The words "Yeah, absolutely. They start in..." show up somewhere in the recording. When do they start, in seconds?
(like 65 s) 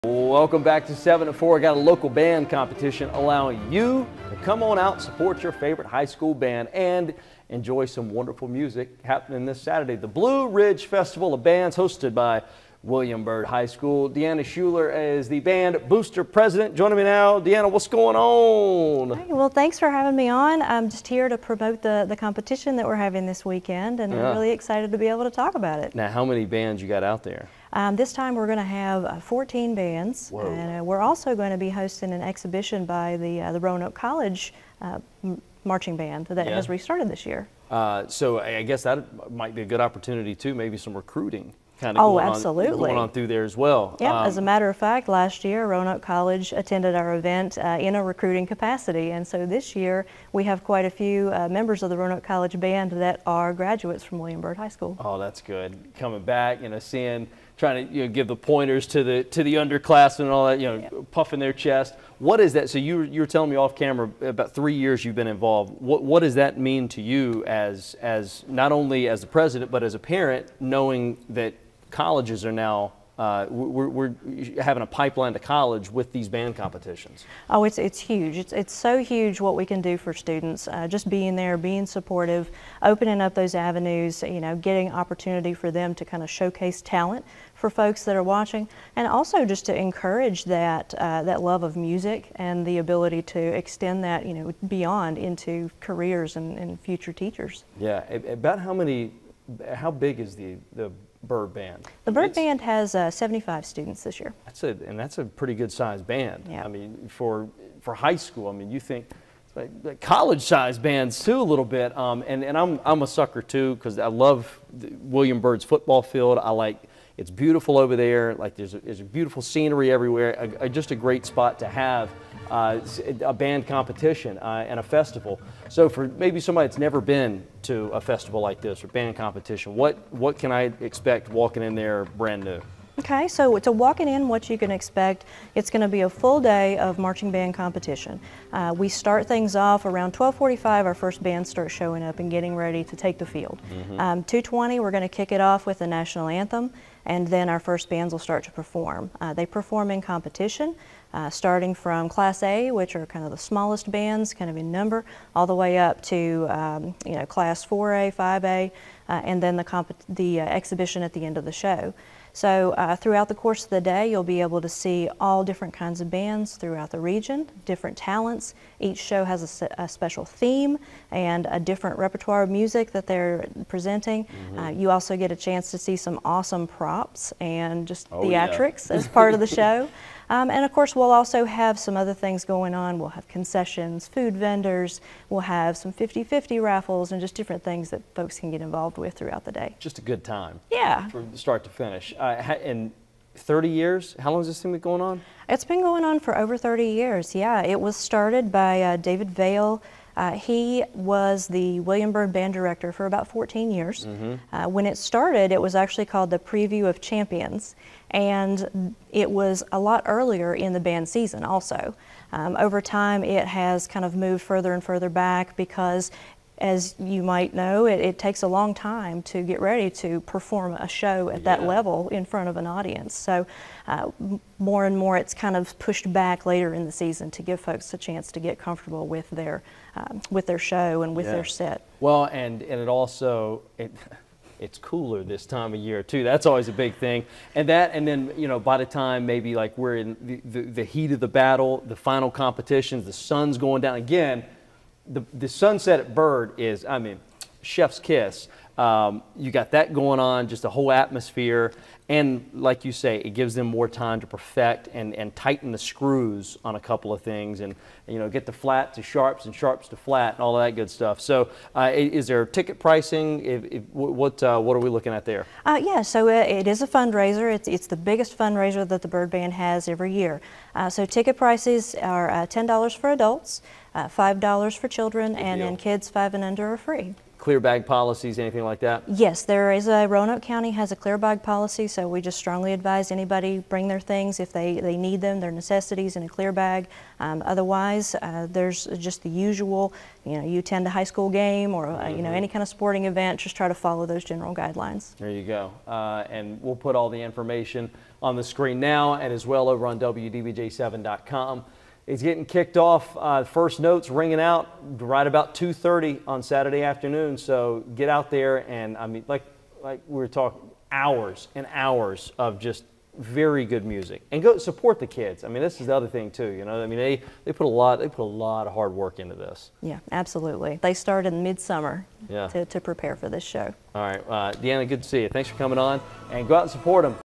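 319 s.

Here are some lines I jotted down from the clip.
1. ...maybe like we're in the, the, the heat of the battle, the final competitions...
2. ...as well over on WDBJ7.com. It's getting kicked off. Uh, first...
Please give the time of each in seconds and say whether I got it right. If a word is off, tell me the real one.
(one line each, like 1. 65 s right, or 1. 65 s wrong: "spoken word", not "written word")
1. 239 s right
2. 299 s right.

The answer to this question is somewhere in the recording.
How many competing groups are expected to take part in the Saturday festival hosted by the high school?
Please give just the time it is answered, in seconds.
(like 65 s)
29 s.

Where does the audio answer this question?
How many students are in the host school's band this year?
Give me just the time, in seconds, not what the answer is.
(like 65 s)
103 s.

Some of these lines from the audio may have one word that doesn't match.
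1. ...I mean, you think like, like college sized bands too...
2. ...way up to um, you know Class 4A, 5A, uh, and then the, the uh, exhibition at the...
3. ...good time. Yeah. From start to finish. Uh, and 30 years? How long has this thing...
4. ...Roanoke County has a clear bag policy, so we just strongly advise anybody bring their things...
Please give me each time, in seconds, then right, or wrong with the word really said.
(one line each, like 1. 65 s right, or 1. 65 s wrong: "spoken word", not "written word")
1. 108 s right
2. 155 s right
3. 190 s right
4. 280 s right.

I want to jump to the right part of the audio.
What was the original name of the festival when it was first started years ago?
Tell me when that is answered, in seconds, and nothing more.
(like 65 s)
206 s.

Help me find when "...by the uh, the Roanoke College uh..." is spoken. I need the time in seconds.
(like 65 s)
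32 s.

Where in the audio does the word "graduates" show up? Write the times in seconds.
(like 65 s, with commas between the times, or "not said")
53 s.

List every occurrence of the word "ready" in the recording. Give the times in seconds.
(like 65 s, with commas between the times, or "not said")
142 s, 219 s.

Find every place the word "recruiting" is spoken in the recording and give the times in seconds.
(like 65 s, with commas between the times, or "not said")
40 s, 48 s.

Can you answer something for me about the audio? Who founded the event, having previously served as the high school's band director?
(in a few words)
David Vale.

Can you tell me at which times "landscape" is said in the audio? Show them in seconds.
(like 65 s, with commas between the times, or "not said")
not said.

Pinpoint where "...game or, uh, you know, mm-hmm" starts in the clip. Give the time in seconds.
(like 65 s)
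291 s.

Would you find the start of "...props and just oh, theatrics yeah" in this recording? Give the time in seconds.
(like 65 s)
176 s.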